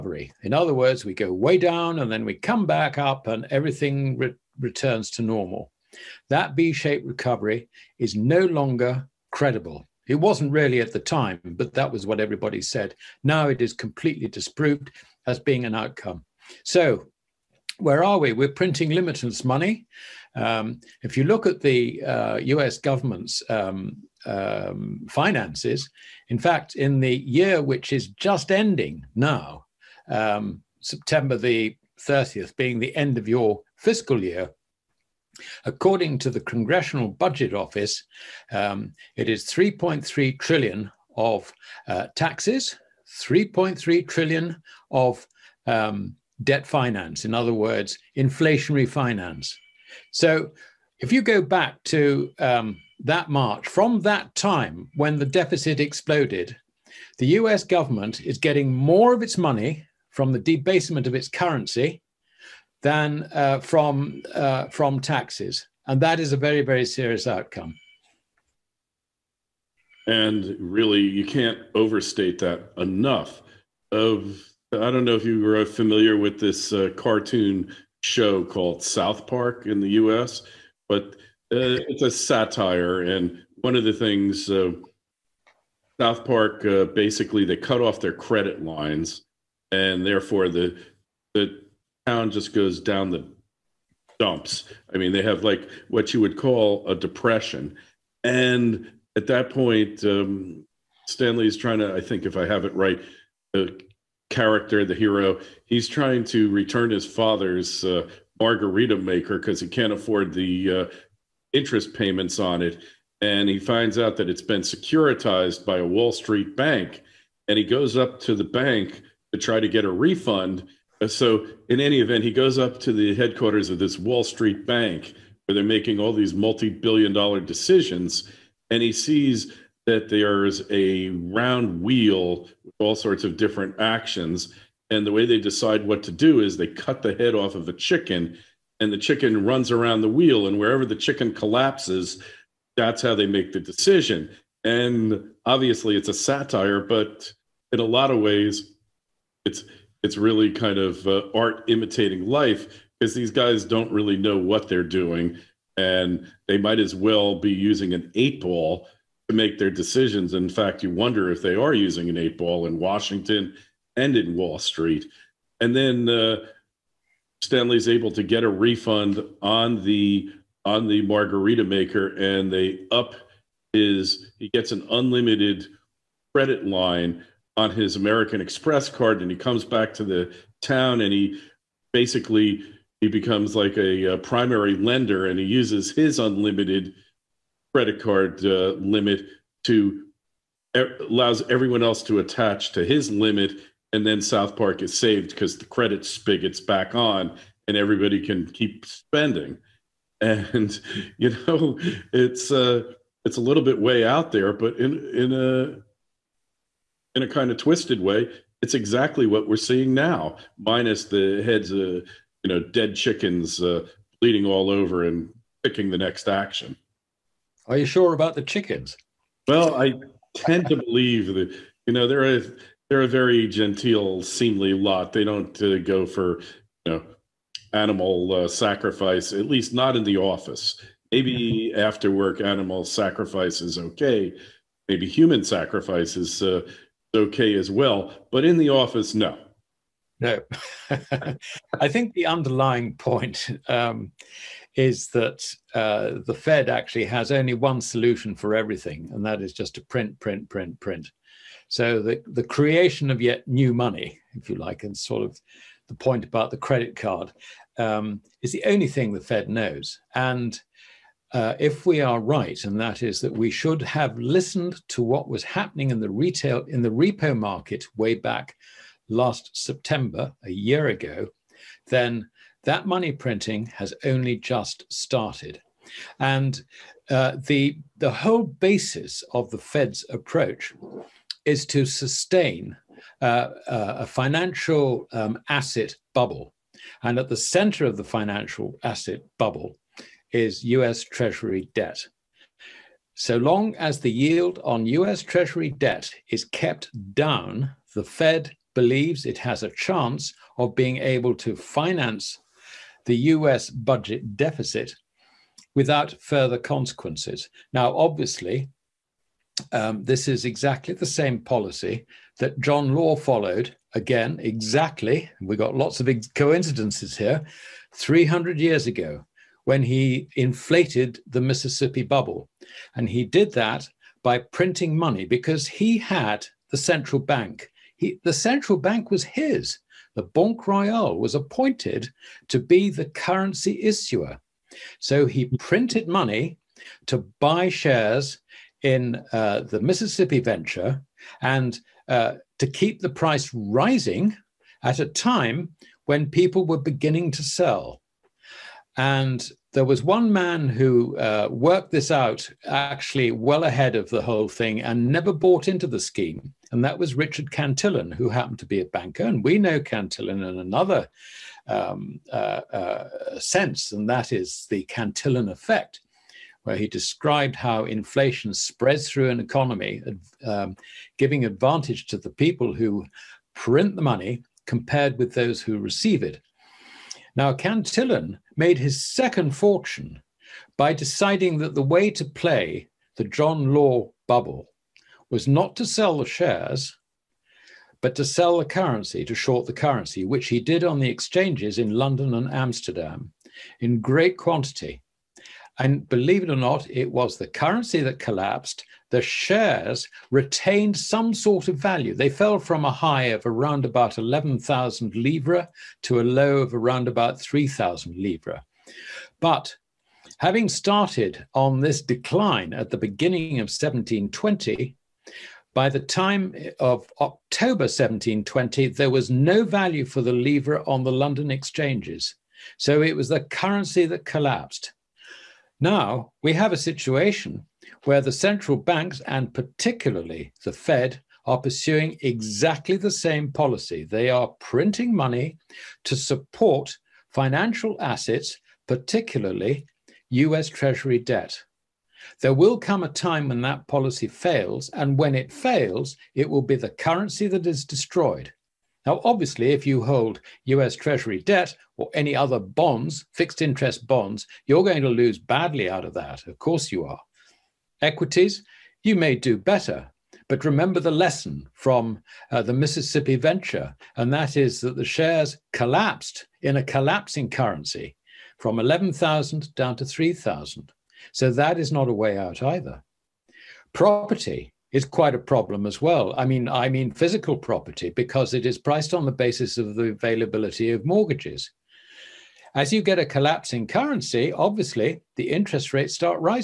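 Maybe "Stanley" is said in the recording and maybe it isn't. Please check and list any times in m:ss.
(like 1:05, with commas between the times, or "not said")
1:41, 2:47.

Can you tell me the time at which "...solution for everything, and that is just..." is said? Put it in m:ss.
4:07.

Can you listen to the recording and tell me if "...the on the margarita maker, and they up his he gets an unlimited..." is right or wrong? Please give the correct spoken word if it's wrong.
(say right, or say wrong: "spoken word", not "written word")
right.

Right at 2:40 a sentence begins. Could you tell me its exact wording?
In fact, you wonder if they are using an eight ball in Washington and in Wall Street.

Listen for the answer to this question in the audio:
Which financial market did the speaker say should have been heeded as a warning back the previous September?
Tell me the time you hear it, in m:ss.
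4:27.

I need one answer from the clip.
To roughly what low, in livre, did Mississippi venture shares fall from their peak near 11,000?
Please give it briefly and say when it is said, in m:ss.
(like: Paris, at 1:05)
3,000 livre, at 6:47.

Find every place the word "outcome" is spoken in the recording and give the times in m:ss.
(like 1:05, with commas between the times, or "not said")
0:15, 1:07.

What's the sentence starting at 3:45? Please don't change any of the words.
They don't uh, go for you know animal uh, sacrifice, at least not in the office.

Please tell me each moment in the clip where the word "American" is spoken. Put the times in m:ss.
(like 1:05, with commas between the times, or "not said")
2:57.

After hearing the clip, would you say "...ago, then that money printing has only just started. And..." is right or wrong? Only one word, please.
right.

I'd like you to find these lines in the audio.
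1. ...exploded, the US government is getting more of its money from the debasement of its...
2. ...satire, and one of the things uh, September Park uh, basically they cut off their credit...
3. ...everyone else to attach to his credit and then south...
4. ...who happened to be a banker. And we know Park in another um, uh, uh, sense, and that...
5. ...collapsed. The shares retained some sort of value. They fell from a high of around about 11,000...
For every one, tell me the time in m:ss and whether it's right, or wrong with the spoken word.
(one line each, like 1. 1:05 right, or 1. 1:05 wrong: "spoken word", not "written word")
1. 0:55 right
2. 1:22 wrong: "South", not "September"
3. 3:11 wrong: "limit", not "credit"
4. 5:58 wrong: "Cantillon", not "Park"
5. 6:38 right.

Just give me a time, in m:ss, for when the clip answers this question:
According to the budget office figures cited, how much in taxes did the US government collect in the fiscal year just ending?
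0:39.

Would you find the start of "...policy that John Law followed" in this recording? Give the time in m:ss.
5:11.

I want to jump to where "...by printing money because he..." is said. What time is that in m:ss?
5:24.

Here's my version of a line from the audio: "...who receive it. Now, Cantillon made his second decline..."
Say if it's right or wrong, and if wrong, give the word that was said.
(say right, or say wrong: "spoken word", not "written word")
wrong: "fortune", not "decline".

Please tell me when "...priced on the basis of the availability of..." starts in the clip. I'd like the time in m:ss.
7:58.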